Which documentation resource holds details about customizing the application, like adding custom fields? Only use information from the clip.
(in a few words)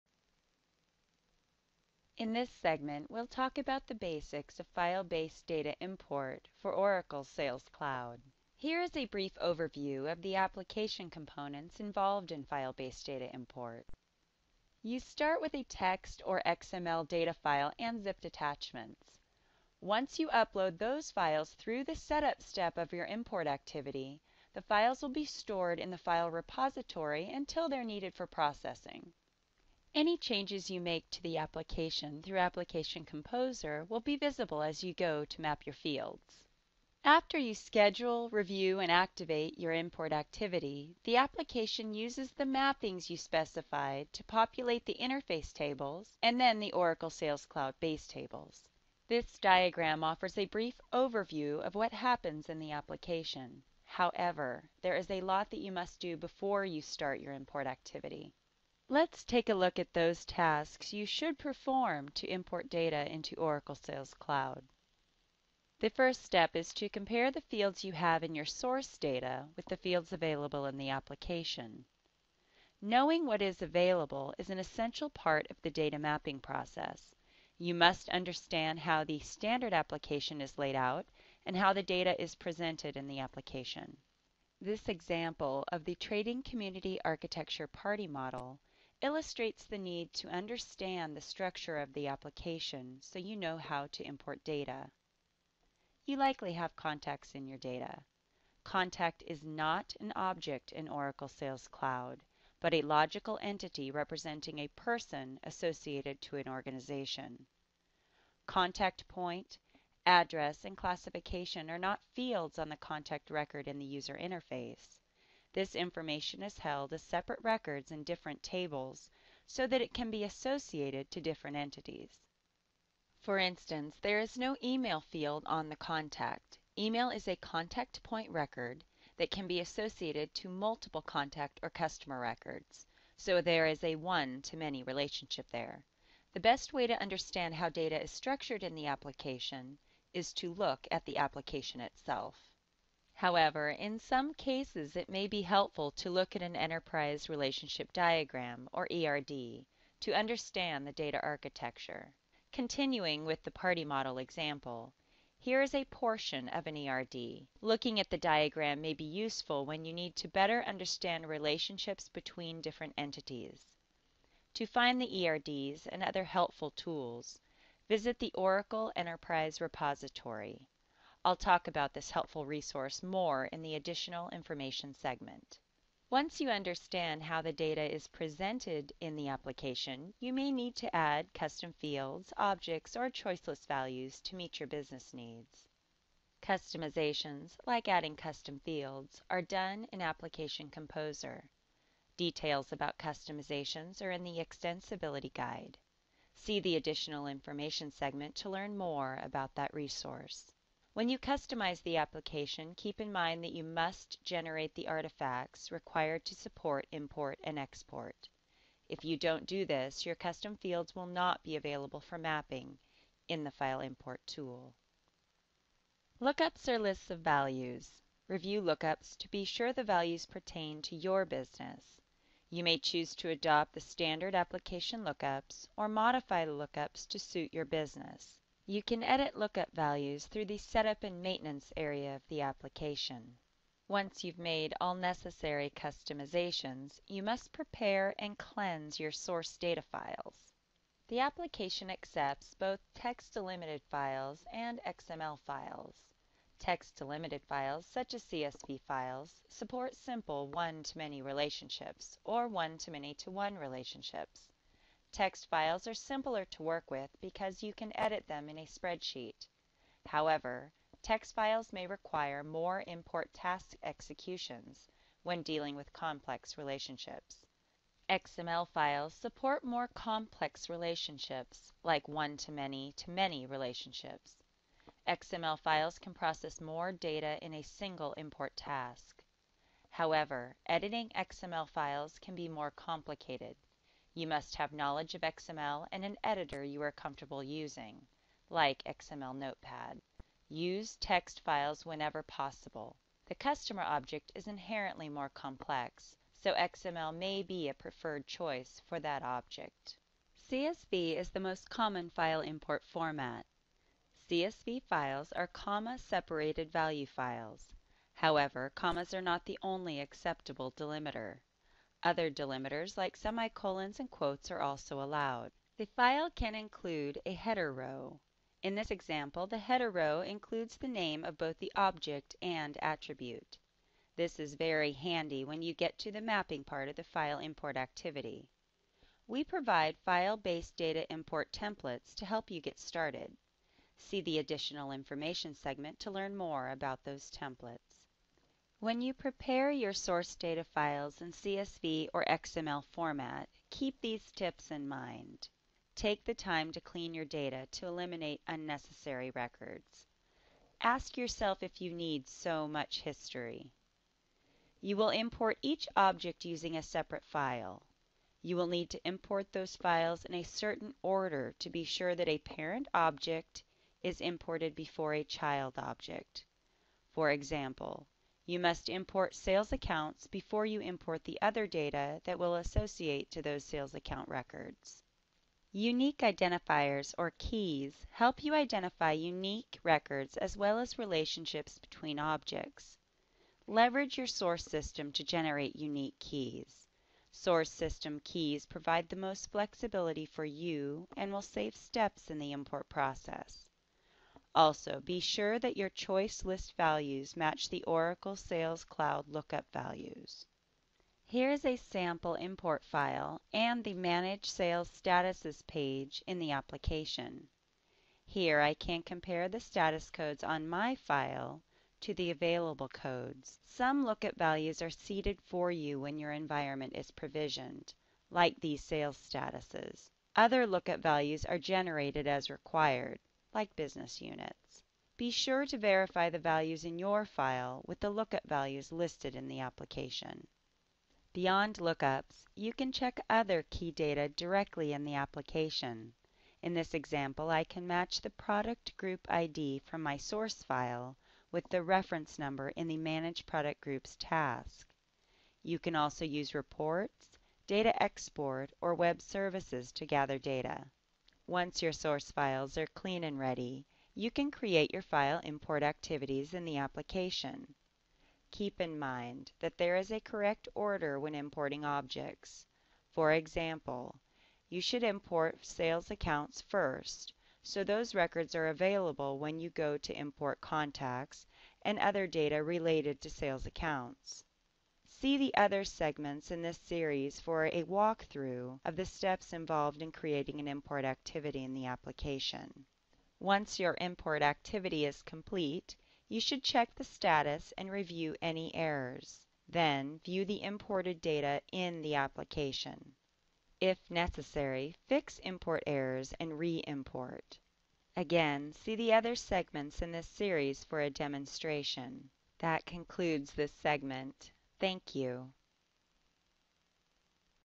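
Extensibility Guide.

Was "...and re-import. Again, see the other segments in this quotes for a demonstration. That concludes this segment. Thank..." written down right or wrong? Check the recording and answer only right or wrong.
wrong.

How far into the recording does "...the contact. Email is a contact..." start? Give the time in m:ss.
2:05.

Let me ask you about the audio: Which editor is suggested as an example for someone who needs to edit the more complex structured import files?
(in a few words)
XML Notepad.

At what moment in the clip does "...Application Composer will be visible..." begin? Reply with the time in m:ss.
0:32.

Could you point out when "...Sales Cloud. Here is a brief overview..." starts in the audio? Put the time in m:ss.
0:07.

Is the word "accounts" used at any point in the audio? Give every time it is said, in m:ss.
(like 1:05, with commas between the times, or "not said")
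6:09, 6:13, 7:46, 7:53.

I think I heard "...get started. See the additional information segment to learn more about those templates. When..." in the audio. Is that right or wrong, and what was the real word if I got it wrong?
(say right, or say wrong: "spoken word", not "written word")
right.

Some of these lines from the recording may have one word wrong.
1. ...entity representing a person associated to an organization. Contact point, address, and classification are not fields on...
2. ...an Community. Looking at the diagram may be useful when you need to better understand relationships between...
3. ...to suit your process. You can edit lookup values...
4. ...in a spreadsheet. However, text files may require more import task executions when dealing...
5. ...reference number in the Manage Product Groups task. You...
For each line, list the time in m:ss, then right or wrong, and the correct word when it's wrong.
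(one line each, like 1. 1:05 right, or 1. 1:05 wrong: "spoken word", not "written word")
1. 1:43 right
2. 2:36 wrong: "ERD", not "Community"
3. 3:47 wrong: "business", not "process"
4. 4:18 right
5. 7:21 right.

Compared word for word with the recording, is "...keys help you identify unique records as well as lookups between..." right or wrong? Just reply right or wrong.
wrong.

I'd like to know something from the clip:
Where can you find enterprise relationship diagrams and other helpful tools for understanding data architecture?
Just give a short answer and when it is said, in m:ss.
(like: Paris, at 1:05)
Oracle Enterprise Repository, at 2:48.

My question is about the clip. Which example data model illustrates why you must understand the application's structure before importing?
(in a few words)
Trading Community Architecture Party Model.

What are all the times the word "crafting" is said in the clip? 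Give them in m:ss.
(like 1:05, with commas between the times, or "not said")
not said.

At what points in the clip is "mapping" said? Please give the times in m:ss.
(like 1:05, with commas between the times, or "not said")
0:42, 1:15, 3:32, 5:26.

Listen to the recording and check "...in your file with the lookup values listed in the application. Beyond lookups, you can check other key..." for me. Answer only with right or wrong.
right.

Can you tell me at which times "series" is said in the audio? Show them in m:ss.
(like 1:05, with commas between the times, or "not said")
7:56, 8:20.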